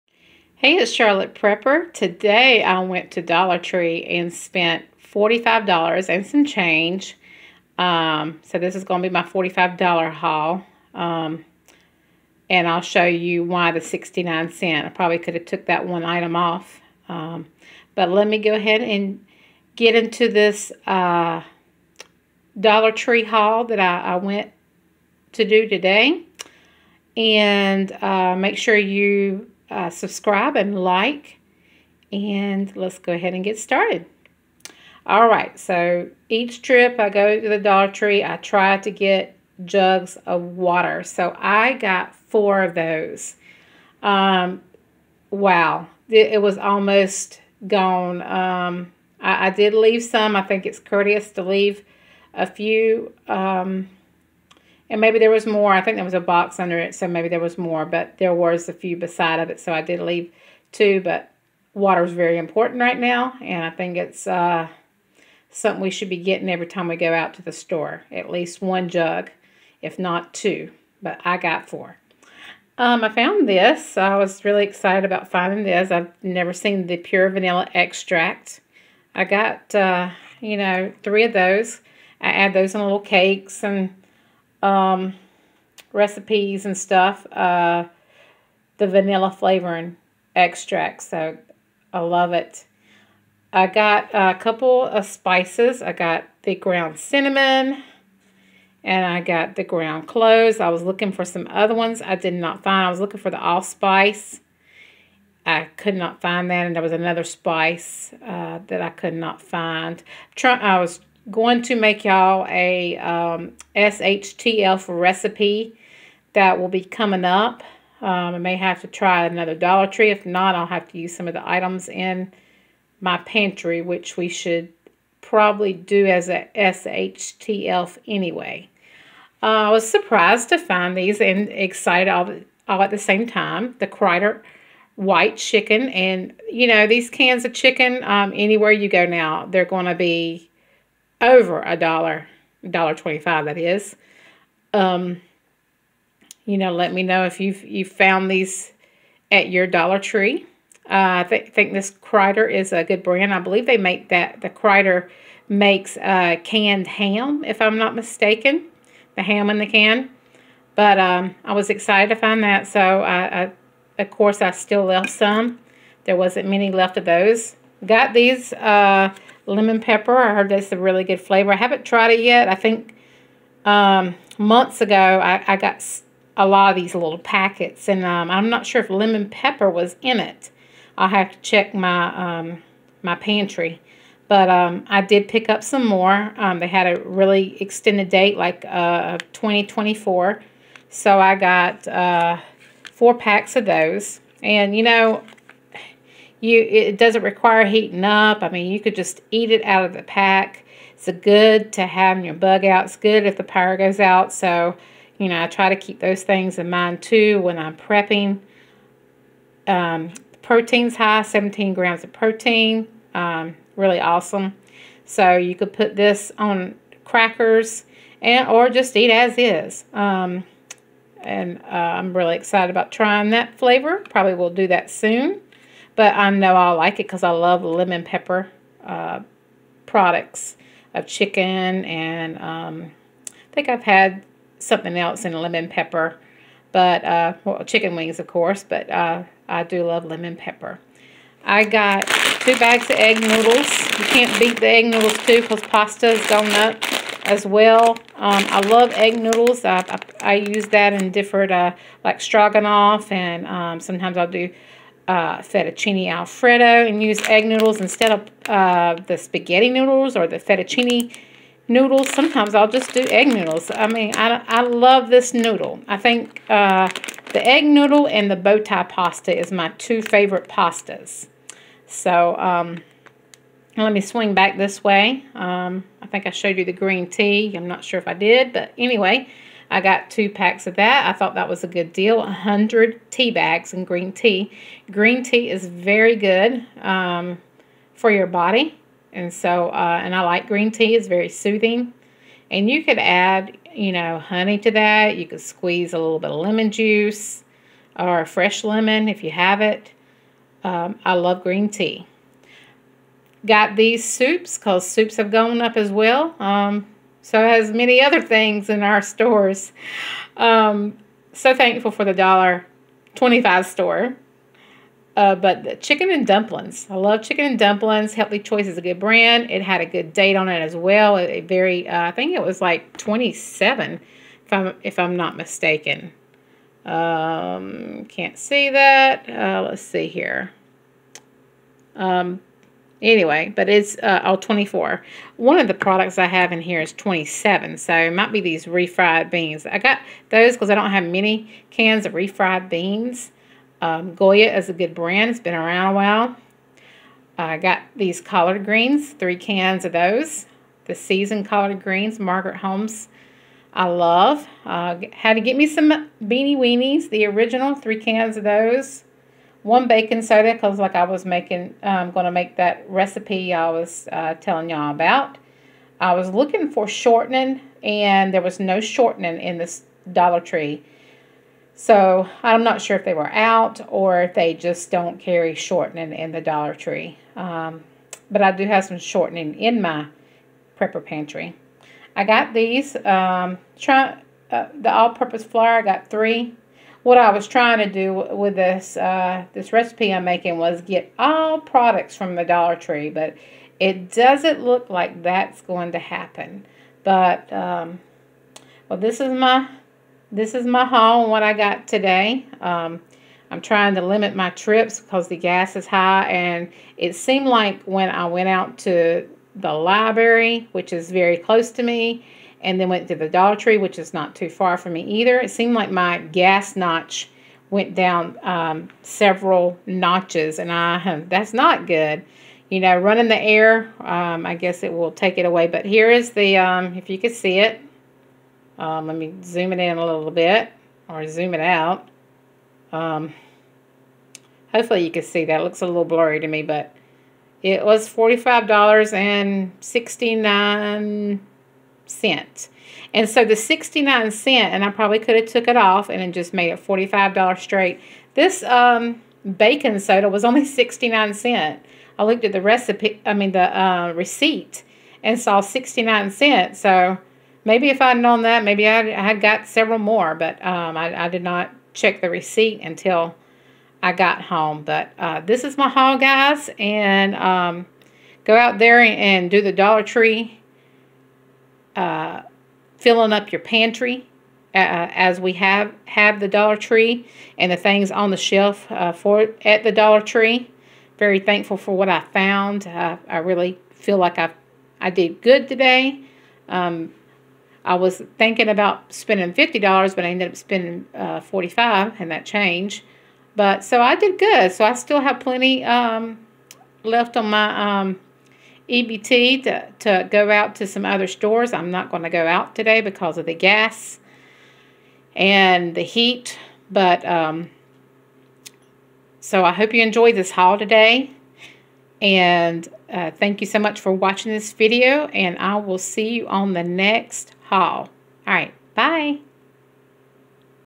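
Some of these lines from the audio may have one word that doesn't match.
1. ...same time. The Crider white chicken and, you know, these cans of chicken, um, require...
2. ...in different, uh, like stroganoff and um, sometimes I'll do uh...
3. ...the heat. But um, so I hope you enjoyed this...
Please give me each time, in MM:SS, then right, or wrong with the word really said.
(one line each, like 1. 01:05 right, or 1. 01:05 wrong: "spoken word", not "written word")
1. 02:12 wrong: "anywhere", not "require"
2. 04:10 right
3. 08:25 right.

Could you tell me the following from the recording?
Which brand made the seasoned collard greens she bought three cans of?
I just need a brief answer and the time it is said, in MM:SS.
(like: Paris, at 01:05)
Margaret Holmes, at 05:52.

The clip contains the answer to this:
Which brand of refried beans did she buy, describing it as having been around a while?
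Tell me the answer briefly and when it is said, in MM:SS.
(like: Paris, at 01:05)
Goya, at 05:44.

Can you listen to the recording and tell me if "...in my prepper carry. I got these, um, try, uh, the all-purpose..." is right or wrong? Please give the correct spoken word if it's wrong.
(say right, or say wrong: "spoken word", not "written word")
wrong: "pantry", not "carry".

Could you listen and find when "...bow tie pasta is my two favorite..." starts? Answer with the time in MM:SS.
04:28.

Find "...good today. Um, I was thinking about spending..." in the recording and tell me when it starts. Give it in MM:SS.
08:05.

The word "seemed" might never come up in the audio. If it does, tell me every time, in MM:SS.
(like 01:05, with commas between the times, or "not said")
06:47, 06:55.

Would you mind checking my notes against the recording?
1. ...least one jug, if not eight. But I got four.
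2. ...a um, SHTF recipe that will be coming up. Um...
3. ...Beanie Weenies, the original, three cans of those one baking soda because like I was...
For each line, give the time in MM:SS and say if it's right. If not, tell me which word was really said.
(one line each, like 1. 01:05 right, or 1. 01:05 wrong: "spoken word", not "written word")
1. 01:08 wrong: "two", not "eight"
2. 01:52 right
3. 05:56 right.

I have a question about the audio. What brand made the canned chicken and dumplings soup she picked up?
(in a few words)
Healthy Choice.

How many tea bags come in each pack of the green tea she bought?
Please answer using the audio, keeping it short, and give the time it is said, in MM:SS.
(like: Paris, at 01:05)
100, at 04:42.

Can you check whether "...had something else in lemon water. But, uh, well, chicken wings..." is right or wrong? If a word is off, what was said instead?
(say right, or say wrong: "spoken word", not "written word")
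wrong: "pepper", not "water".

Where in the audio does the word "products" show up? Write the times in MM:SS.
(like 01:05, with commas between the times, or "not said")
03:49, 05:35, 06:31.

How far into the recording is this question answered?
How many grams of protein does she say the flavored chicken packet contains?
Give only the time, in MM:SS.
03:31.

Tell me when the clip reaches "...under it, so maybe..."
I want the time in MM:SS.
00:56.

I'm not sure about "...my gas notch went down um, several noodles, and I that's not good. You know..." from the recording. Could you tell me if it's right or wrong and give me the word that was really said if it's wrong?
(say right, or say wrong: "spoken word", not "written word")
wrong: "notches", not "noodles".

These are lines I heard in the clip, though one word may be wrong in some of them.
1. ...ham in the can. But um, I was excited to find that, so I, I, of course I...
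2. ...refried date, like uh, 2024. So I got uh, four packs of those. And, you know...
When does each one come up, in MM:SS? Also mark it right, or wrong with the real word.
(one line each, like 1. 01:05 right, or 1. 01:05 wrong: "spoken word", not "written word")
1. 02:39 right
2. 03:07 wrong: "extended", not "refried".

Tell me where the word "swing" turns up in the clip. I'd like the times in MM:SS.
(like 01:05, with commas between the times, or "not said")
04:34.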